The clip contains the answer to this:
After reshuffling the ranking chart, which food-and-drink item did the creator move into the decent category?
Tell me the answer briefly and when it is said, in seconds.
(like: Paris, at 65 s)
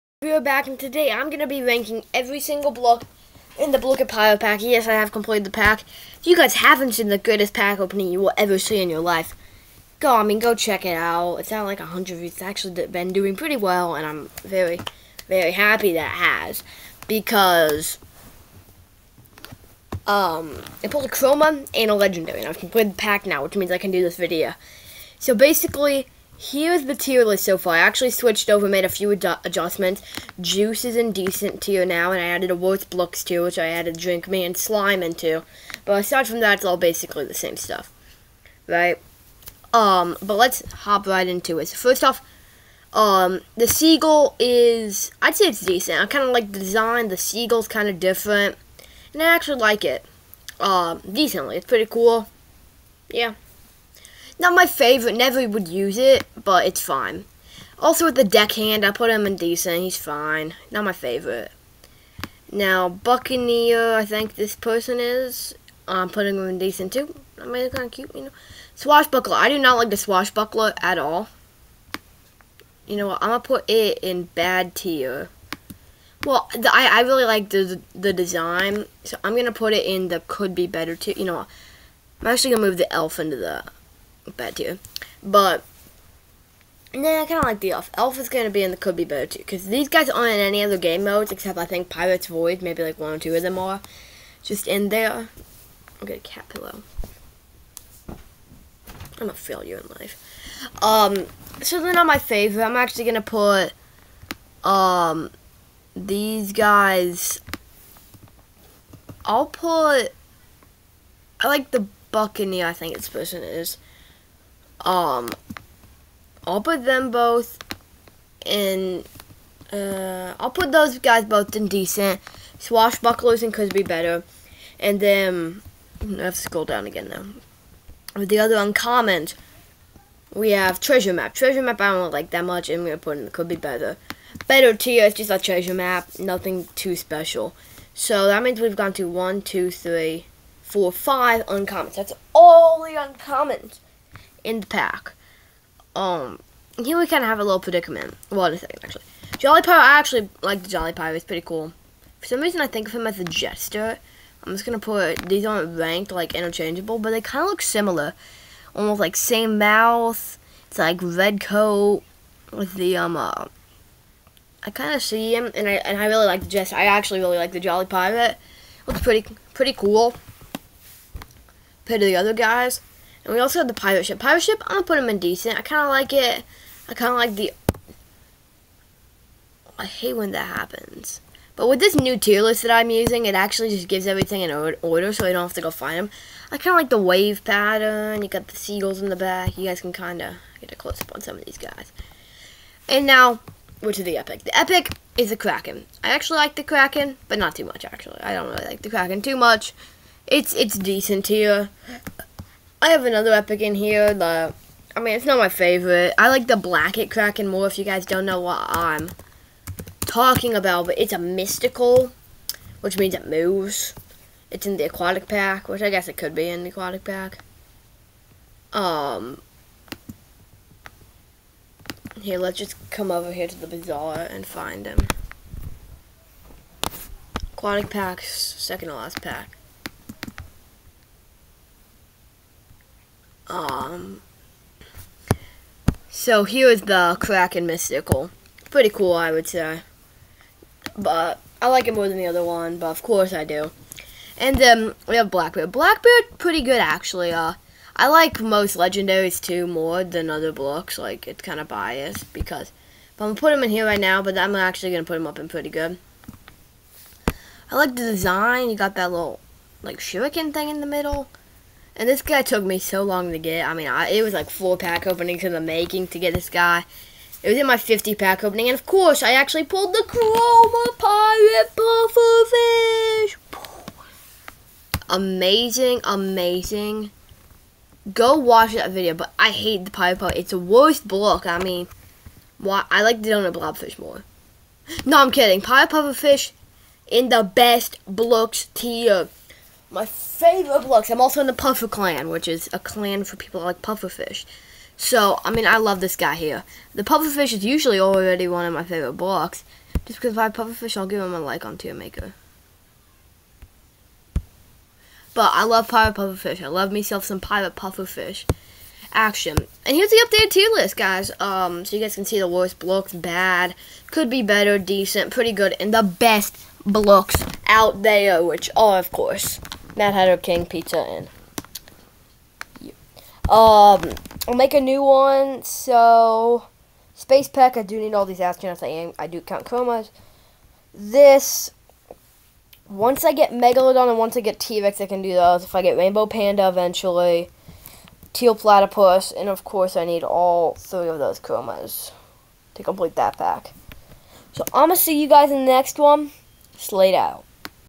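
Juice, at 30 s.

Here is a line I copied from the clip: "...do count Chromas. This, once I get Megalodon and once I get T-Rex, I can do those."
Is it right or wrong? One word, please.
right.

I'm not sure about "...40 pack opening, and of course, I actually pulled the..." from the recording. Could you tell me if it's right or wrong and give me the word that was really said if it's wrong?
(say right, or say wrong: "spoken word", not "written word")
wrong: "50", not "40".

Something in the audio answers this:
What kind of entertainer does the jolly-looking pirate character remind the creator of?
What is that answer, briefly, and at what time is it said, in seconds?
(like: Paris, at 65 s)
A jester, at 152 s.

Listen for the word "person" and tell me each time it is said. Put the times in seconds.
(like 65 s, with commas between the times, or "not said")
64 s, 113 s.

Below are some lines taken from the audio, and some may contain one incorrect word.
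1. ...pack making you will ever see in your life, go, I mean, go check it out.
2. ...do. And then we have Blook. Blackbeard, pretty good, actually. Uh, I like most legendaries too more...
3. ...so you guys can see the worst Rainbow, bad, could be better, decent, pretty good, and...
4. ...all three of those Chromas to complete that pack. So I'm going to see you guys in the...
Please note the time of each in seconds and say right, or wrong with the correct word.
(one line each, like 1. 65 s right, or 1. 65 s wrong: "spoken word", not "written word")
1. 7 s wrong: "opening", not "making"
2. 243 s wrong: "Blackbeard", not "Blook"
3. 311 s wrong: "Blooks", not "Rainbow"
4. 340 s right.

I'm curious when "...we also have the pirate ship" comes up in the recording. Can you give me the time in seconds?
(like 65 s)
173 s.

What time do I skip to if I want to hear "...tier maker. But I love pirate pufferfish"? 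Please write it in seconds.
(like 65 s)
301 s.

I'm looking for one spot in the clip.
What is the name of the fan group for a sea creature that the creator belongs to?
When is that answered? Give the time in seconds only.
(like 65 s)
291 s.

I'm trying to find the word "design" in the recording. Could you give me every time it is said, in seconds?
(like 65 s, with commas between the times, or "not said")
46 s, 78 s, 257 s.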